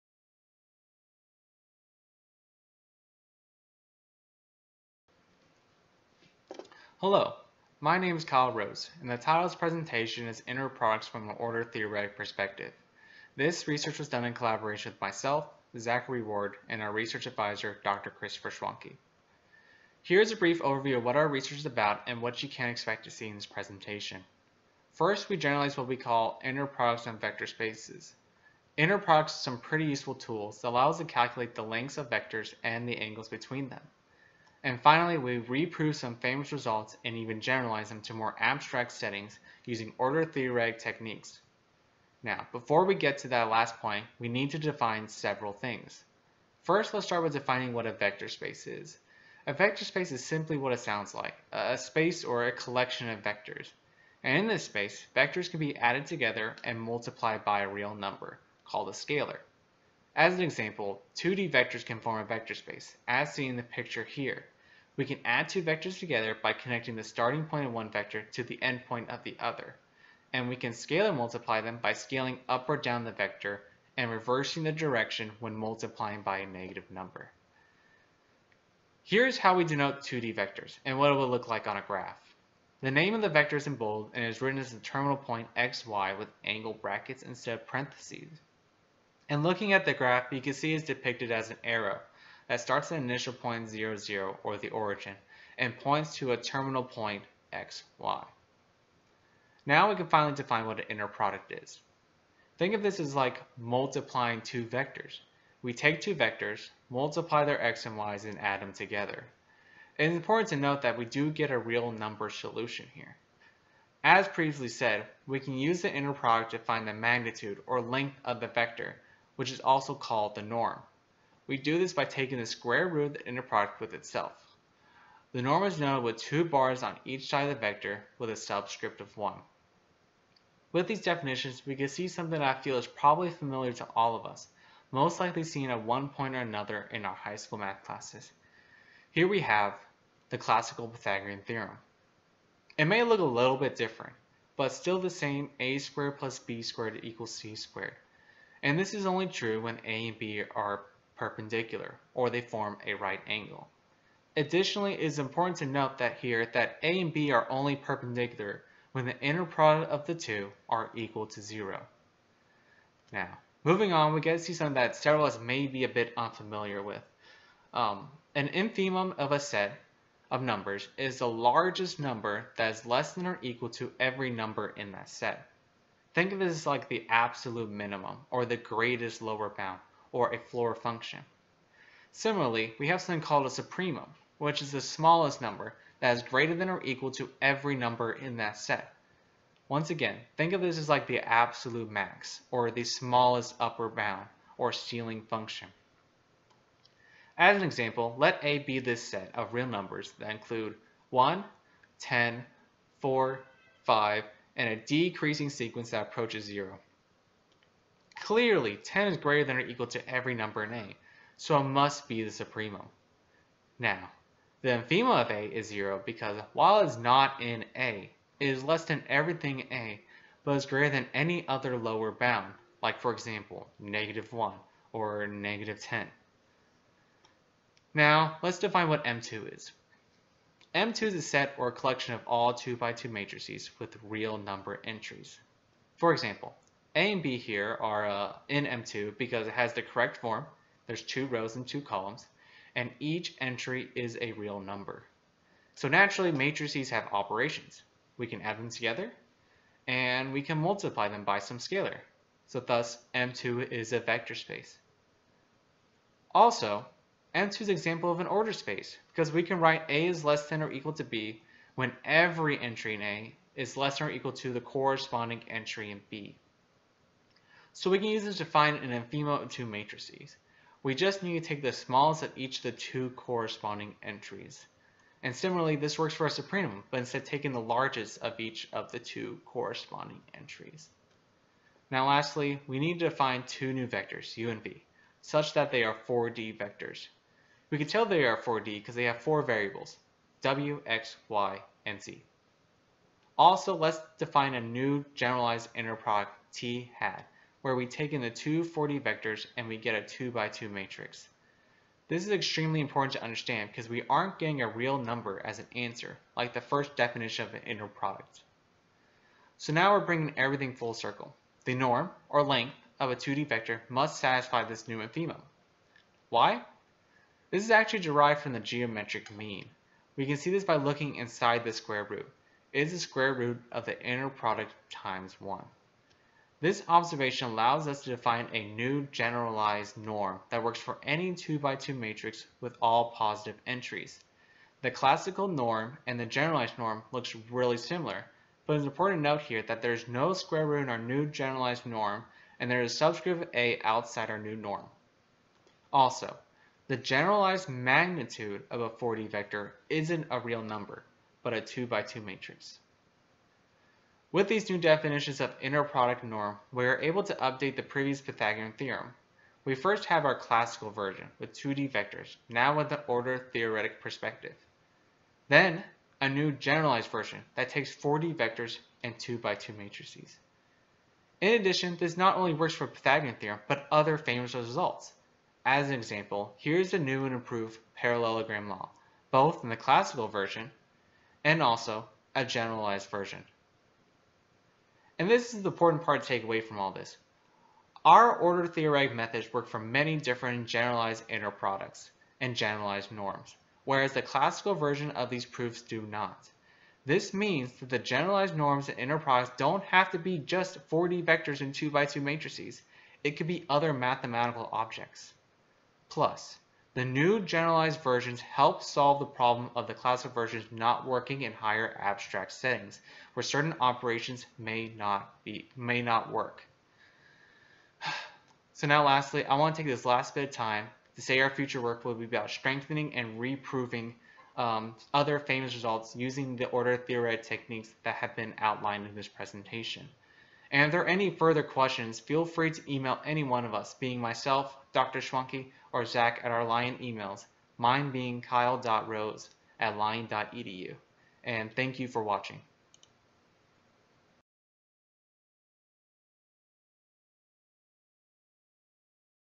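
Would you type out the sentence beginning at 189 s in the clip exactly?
Once again, think of this as like the absolute max, or the smallest upper bound, or ceiling function.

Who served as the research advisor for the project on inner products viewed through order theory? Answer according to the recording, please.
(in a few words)
Dr. Christopher Schwanke.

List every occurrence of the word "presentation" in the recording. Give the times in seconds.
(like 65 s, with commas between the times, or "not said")
9 s, 23 s, 429 s.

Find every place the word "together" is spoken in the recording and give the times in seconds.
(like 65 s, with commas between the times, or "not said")
56 s, 65 s, 108 s, 248 s.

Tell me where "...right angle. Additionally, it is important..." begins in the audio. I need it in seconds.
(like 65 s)
152 s.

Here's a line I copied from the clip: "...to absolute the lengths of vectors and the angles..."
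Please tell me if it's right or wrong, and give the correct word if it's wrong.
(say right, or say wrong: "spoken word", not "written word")
wrong: "calculate", not "absolute".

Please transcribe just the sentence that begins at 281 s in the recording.
Now lastly, we need to define two new vectors, u and v, such that they are 4D vectors.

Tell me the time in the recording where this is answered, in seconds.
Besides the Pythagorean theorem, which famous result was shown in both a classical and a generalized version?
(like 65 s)
377 s.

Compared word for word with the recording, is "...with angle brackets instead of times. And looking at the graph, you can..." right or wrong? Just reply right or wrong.
wrong.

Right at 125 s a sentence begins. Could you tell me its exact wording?
The norm is known with two bars on each side of the vector with a subscript of 1.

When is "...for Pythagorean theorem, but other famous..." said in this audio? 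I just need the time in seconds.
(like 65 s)
372 s.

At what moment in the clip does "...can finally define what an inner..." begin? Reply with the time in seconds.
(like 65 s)
99 s.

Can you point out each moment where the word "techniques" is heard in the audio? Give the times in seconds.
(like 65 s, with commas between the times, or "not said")
40 s, 427 s.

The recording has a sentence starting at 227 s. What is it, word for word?
Now, let's define what M2 is.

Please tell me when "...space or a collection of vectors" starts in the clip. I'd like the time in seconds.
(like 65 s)
51 s.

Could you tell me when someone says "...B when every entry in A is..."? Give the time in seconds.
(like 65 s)
261 s.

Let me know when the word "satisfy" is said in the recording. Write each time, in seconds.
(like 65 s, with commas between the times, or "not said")
314 s.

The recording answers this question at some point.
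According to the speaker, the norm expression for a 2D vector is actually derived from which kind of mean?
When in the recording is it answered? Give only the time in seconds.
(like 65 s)
318 s.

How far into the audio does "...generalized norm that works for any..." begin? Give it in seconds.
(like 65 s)
329 s.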